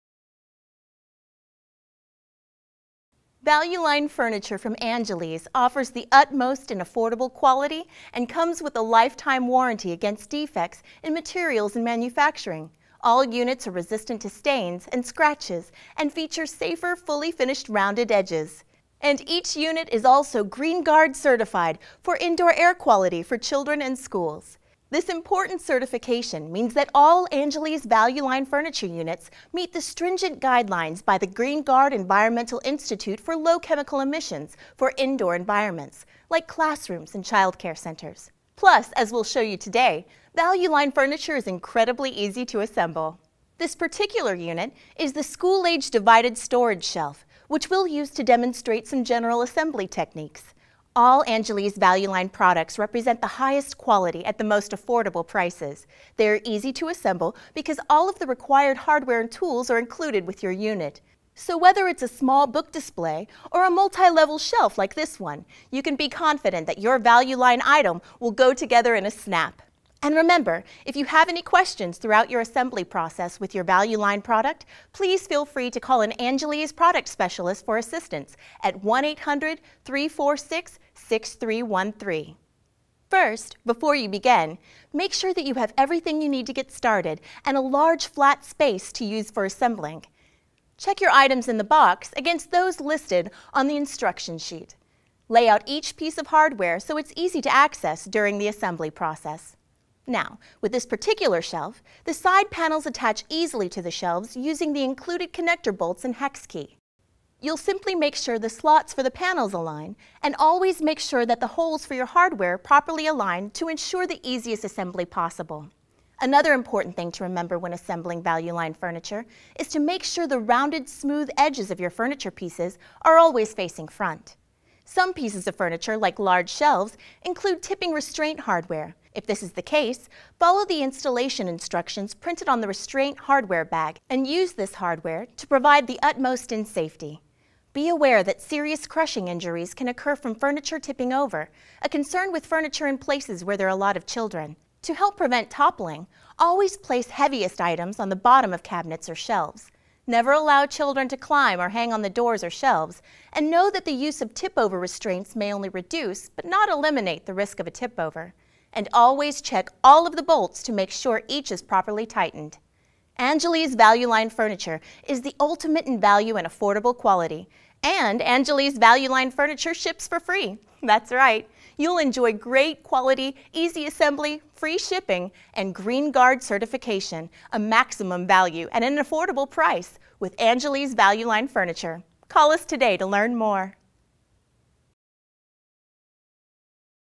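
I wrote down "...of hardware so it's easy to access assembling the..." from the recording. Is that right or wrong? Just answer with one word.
wrong.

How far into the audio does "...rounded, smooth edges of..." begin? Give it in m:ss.
2:00.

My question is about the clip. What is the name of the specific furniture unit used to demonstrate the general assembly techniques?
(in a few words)
school-age divided storage shelf.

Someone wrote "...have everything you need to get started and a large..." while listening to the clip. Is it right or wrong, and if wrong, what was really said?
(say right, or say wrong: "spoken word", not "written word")
right.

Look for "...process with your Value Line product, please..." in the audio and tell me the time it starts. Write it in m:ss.
1:12.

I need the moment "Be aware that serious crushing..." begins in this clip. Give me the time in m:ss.
2:17.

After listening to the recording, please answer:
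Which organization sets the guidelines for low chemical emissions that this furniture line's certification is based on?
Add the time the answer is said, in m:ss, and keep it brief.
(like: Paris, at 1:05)
Green Guard Environmental Institute, at 0:31.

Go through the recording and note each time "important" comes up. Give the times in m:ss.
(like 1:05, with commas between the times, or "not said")
0:25, 1:56.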